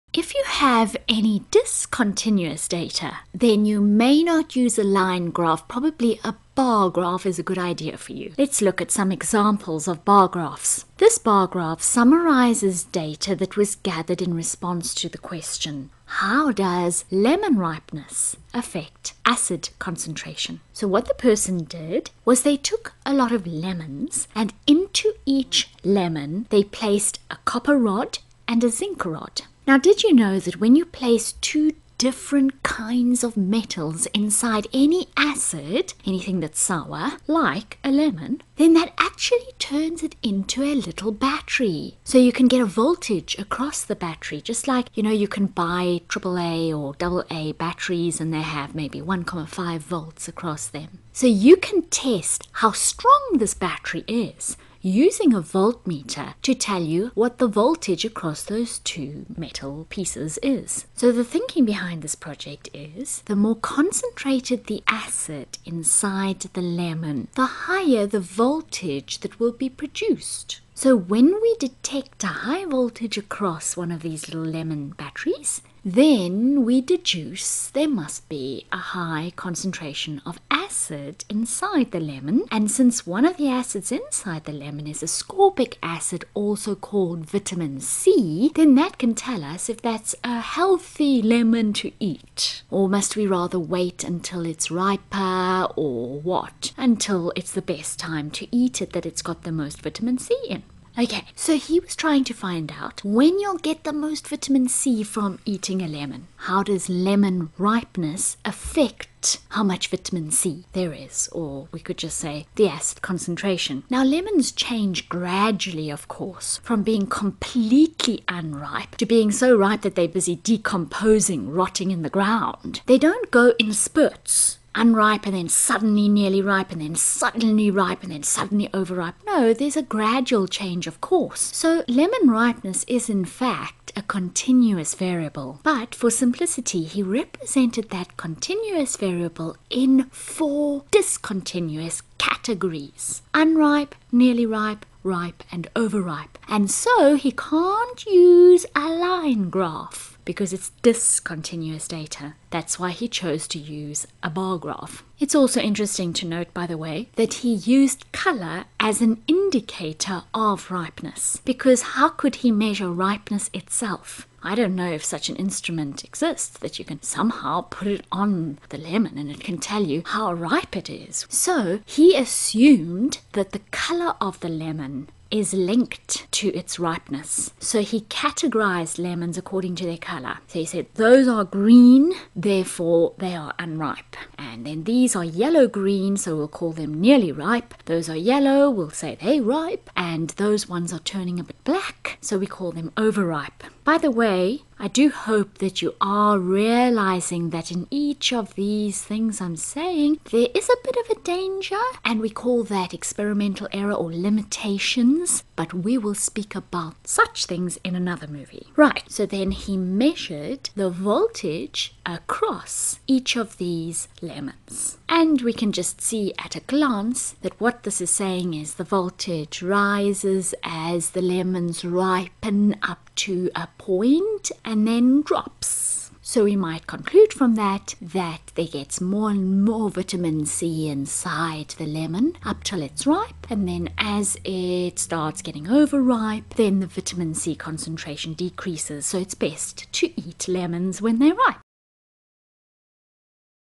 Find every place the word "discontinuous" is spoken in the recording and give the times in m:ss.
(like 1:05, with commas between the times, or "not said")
0:01, 2:20, 2:30.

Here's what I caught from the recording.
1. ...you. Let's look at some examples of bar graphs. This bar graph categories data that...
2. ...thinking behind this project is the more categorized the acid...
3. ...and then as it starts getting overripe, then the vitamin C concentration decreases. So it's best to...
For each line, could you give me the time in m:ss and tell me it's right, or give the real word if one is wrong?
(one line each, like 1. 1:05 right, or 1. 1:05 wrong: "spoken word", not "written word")
1. 0:08 wrong: "summarizes", not "categories"
2. 1:01 wrong: "concentrated", not "categorized"
3. 3:53 right.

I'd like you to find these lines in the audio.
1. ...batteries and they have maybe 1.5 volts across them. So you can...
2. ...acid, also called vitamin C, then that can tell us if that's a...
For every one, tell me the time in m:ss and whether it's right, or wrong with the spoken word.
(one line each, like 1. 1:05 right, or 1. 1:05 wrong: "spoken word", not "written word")
1. 0:47 right
2. 1:25 right.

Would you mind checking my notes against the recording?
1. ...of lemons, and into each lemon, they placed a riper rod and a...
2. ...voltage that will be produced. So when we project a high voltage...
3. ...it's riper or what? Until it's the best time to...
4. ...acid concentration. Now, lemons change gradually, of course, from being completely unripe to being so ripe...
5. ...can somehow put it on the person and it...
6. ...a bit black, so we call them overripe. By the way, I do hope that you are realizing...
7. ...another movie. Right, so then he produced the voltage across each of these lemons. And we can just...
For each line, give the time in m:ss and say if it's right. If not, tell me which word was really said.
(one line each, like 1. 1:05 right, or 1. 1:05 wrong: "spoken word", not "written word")
1. 0:23 wrong: "copper", not "riper"
2. 1:08 wrong: "detect", not "project"
3. 1:34 right
4. 1:52 right
5. 2:46 wrong: "lemon", not "person"
6. 3:11 right
7. 3:27 wrong: "measured", not "produced".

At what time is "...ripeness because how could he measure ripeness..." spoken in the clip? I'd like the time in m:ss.
2:40.